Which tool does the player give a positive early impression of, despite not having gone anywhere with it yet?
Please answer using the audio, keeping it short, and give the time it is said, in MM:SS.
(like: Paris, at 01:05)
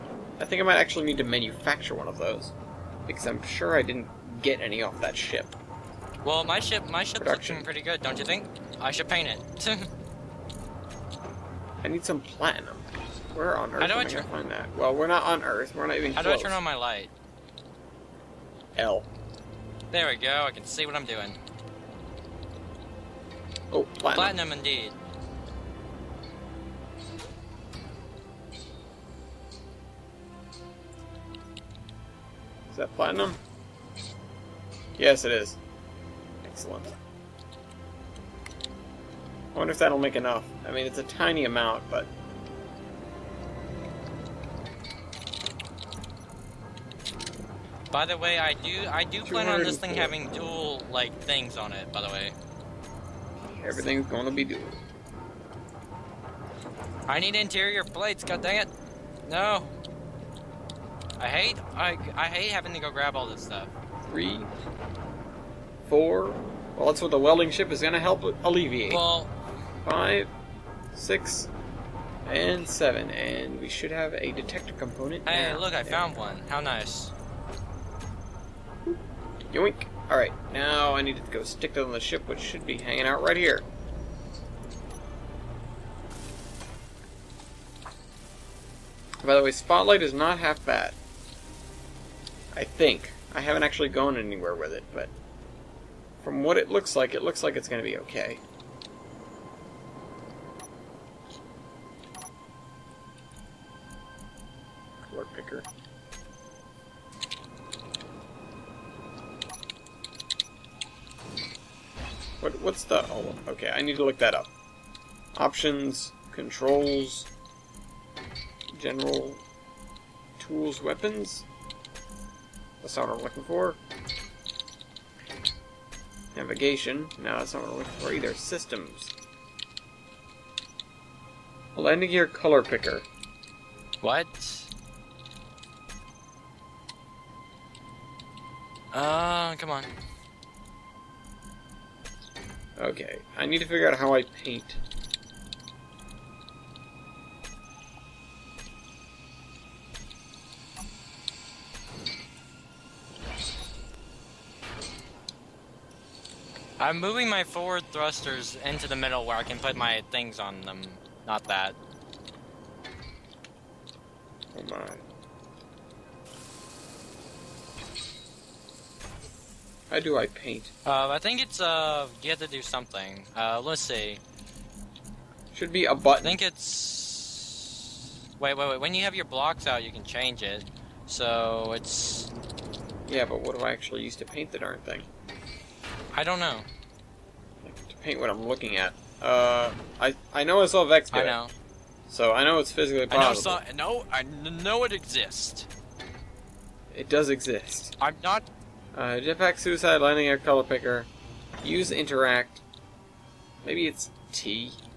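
Spotlight, at 01:29.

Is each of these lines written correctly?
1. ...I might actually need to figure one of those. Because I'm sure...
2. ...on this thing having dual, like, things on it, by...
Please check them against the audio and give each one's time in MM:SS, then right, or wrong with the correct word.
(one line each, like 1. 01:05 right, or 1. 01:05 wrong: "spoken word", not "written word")
1. 00:00 wrong: "manufacture", not "figure"
2. 00:49 right.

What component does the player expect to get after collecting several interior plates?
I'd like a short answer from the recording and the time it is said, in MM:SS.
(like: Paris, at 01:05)
detector component, at 01:14.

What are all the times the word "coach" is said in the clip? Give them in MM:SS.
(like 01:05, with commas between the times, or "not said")
not said.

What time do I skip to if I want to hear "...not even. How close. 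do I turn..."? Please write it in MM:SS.
00:15.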